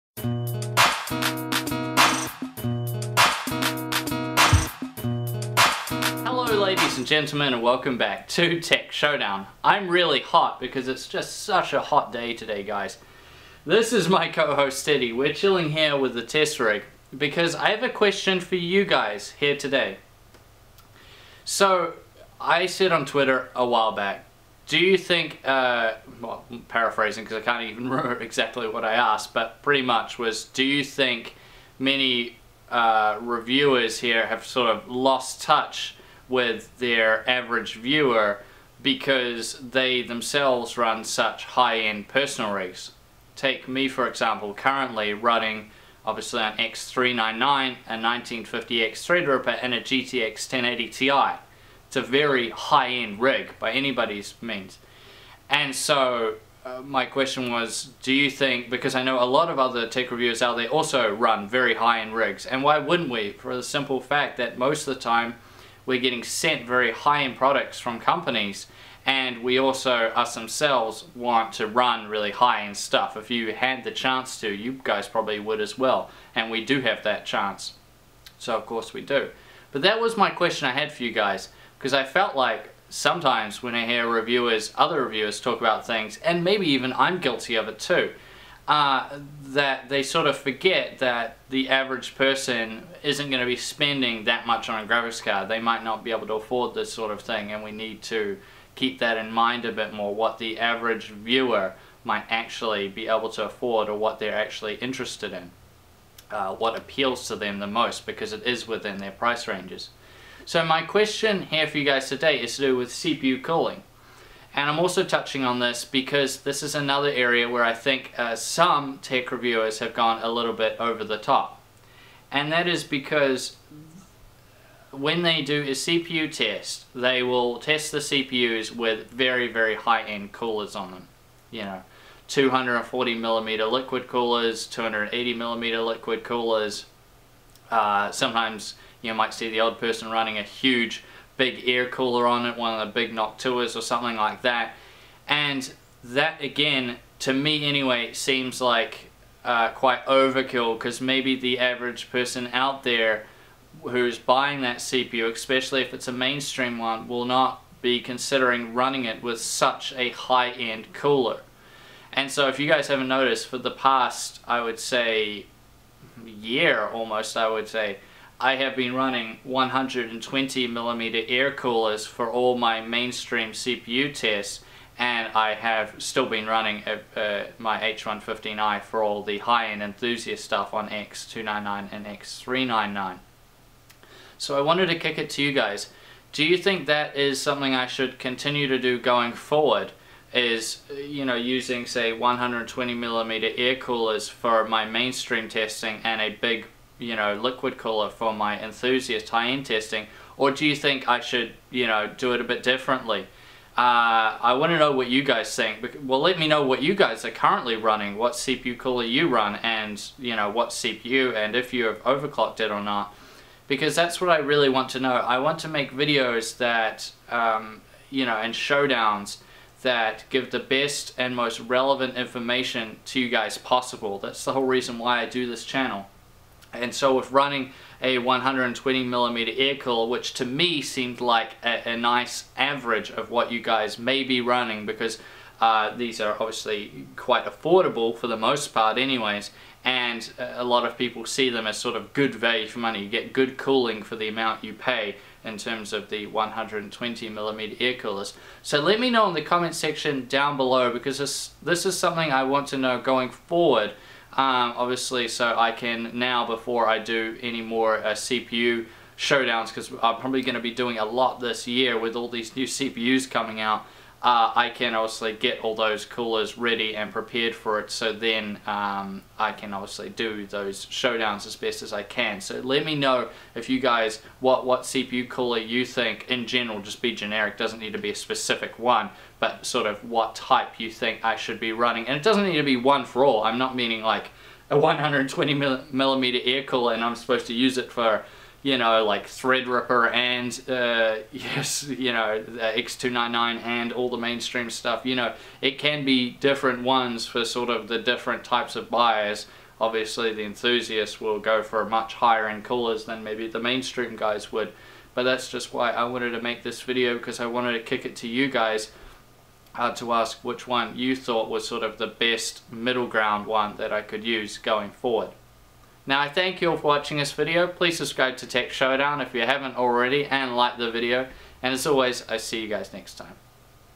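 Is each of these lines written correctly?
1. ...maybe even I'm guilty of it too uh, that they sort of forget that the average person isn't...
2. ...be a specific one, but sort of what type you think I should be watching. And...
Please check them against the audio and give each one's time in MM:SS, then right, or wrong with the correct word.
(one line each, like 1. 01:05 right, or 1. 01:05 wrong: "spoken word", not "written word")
1. 01:26 right
2. 04:37 wrong: "running", not "watching".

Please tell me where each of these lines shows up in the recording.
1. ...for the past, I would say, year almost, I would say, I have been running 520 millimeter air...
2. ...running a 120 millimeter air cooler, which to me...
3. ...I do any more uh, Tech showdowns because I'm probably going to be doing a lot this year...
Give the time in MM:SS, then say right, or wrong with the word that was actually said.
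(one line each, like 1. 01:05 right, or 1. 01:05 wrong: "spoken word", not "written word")
1. 02:43 wrong: "120", not "520"
2. 03:47 right
3. 04:16 wrong: "CPU", not "Tech".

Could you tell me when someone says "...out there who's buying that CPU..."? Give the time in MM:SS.
02:32.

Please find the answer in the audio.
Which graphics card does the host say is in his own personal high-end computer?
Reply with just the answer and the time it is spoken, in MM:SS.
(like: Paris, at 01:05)
GTX 1080 Ti, at 00:49.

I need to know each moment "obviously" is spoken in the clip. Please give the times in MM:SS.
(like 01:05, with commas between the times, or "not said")
00:46, 03:56, 04:14, 04:24, 04:29, 04:59.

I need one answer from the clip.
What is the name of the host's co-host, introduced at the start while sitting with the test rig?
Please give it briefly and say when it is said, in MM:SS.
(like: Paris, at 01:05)
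Steady, at 00:14.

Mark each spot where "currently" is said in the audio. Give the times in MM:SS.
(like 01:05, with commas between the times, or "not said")
00:44, 03:27.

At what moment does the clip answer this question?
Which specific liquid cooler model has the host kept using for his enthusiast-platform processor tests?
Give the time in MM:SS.
02:57.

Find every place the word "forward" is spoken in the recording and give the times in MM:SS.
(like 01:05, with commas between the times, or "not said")
03:09, 04:13, 05:14.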